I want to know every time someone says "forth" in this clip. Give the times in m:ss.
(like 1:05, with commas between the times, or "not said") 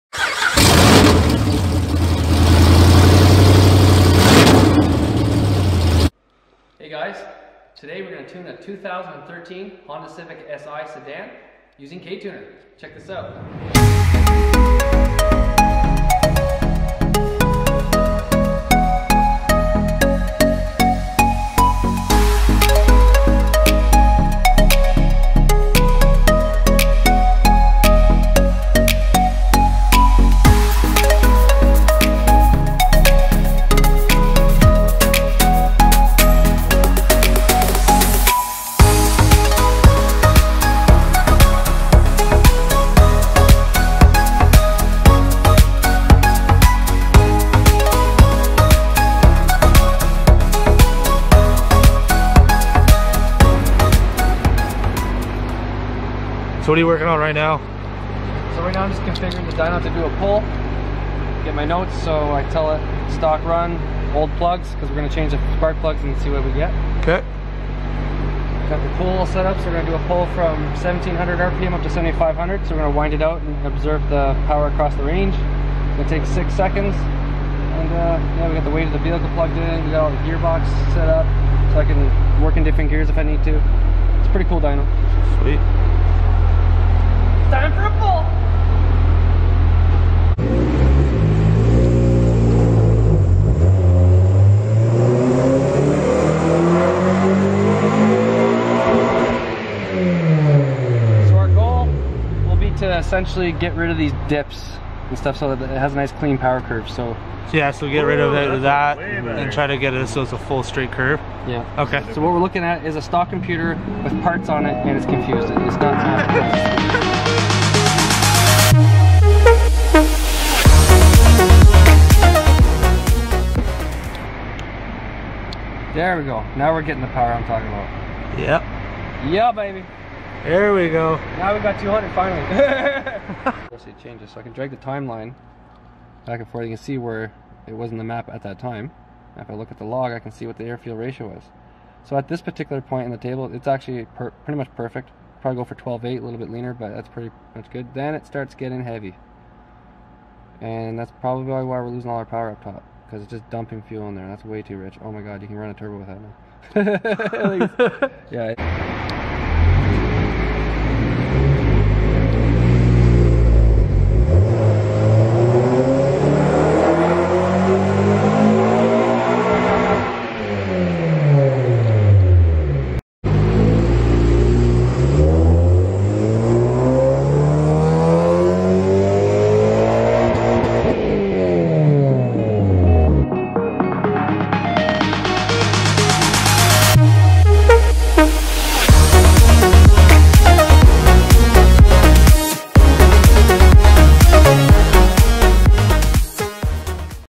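2:16.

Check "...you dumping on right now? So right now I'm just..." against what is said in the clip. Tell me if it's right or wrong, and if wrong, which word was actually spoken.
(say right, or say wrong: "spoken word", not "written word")
wrong: "working", not "dumping".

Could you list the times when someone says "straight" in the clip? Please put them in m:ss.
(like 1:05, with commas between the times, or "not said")
1:50.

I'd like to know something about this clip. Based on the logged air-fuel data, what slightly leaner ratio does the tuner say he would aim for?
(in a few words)
12.8.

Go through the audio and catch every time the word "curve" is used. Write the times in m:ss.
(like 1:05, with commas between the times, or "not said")
1:46, 1:50.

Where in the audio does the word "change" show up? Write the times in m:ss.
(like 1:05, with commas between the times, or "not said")
1:05, 2:14.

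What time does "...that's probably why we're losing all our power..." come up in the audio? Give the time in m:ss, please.
2:30.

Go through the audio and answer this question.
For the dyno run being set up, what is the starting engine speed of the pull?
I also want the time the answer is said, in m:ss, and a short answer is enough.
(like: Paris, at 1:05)
1700 RPM, at 1:10.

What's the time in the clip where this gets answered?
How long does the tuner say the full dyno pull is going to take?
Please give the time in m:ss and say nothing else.
1:16.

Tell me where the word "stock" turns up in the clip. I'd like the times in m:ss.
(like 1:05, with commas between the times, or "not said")
1:03, 1:53.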